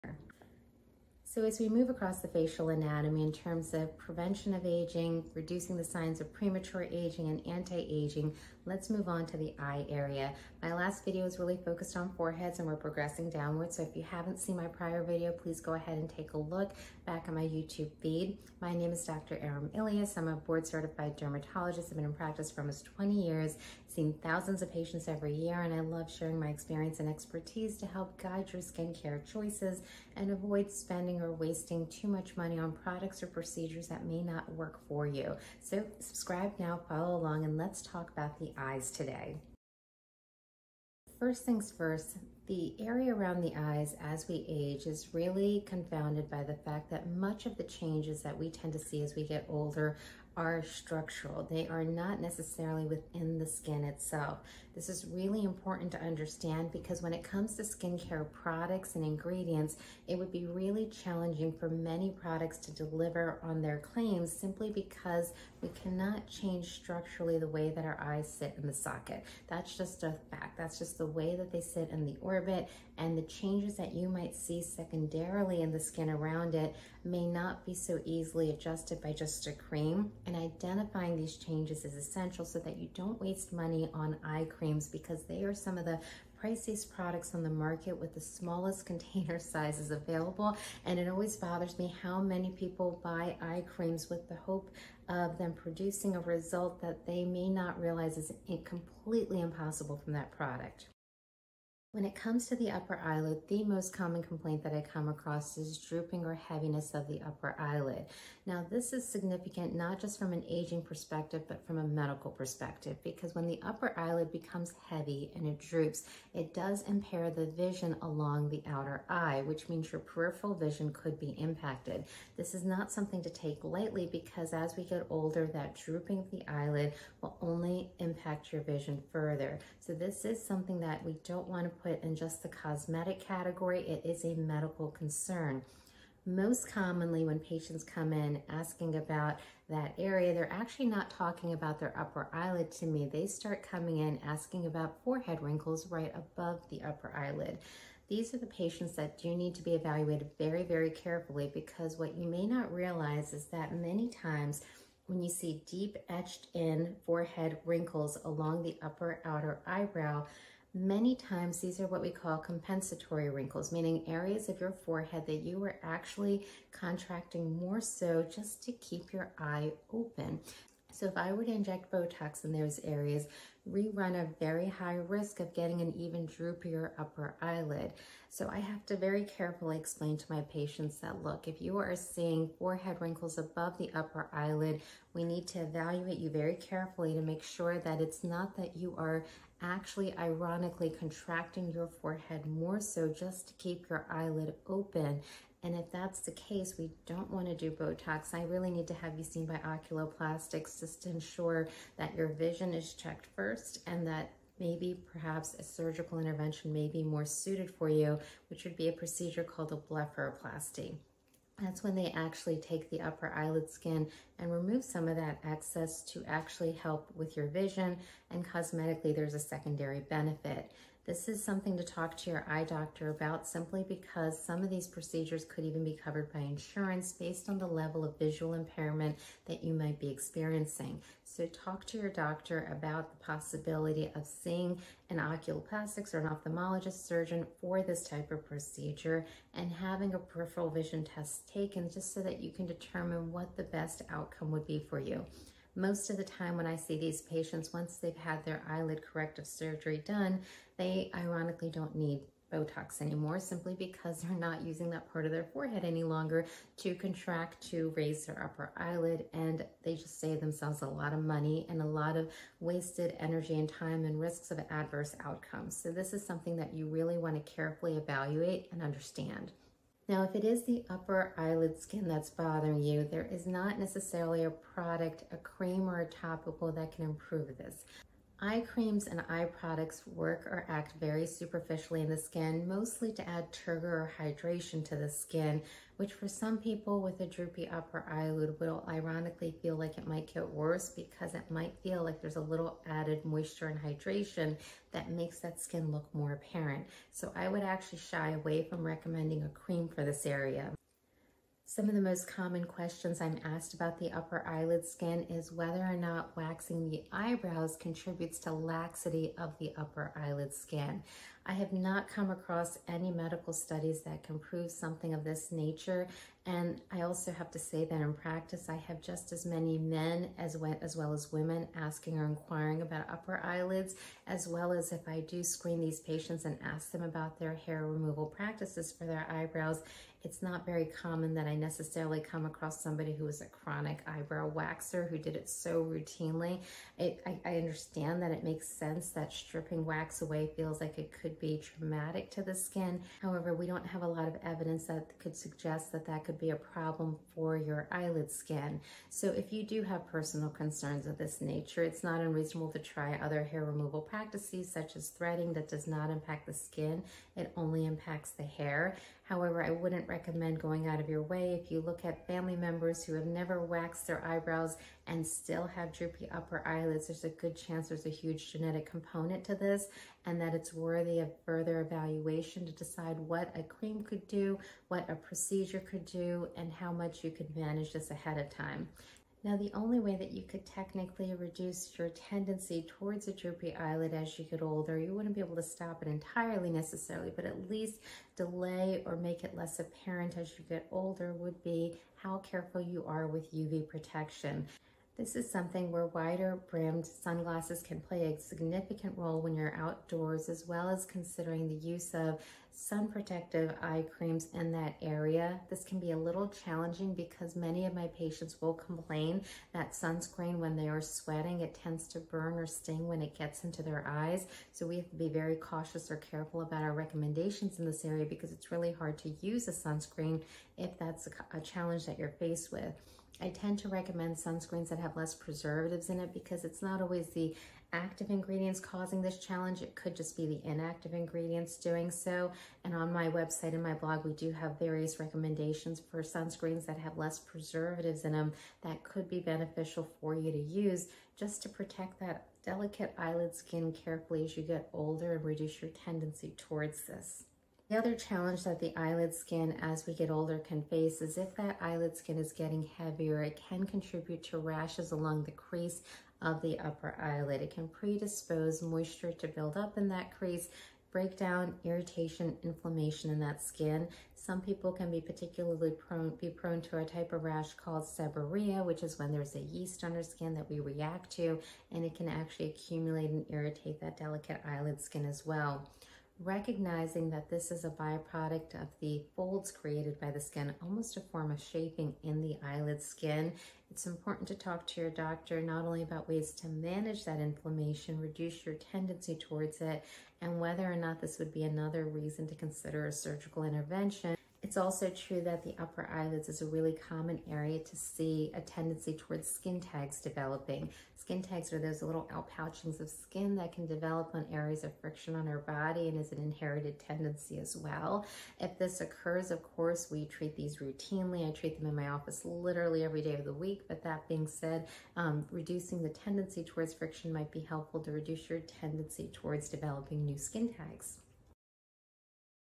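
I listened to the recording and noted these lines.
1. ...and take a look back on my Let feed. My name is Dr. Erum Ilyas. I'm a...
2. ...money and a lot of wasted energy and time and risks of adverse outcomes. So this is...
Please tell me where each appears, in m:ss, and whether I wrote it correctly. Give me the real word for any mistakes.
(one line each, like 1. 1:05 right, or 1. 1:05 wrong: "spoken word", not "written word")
1. 0:15 wrong: "YouTube", not "Let"
2. 4:21 right.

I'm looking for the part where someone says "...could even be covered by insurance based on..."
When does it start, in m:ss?
3:45.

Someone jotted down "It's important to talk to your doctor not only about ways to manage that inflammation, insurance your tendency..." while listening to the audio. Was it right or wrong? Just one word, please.
wrong.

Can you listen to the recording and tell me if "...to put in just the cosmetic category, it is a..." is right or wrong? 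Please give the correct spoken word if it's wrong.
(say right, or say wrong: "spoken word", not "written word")
right.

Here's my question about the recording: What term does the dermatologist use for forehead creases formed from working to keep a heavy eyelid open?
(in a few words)
compensatory wrinkles.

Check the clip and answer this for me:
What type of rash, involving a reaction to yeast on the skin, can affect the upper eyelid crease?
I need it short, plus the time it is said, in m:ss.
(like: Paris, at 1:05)
seborrhea, at 7:48.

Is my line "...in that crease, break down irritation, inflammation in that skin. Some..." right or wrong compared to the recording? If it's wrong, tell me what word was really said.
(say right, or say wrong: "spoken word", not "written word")
right.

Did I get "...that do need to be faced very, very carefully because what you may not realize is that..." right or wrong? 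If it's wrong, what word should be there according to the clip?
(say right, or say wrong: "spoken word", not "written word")
wrong: "evaluated", not "faced".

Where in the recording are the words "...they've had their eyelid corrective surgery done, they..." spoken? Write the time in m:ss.
4:07.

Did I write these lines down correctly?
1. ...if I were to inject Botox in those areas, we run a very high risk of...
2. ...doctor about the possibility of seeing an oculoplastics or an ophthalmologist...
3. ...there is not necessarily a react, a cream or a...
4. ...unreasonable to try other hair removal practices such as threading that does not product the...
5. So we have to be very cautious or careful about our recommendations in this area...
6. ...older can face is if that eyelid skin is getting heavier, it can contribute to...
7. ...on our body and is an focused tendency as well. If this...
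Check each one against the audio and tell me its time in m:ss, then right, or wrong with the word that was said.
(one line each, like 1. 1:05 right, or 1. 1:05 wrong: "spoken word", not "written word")
1. 2:51 right
2. 3:52 right
3. 4:33 wrong: "product", not "react"
4. 5:52 wrong: "impact", not "product"
5. 6:54 right
6. 7:30 right
7. 8:25 wrong: "inherited", not "focused".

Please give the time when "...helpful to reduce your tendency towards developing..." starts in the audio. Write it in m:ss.
8:37.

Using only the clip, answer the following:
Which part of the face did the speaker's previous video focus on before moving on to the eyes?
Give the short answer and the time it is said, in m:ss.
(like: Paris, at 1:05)
foreheads, at 0:12.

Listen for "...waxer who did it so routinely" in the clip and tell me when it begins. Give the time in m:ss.
5:34.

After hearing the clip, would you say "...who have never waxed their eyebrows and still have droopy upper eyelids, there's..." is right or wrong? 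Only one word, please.
right.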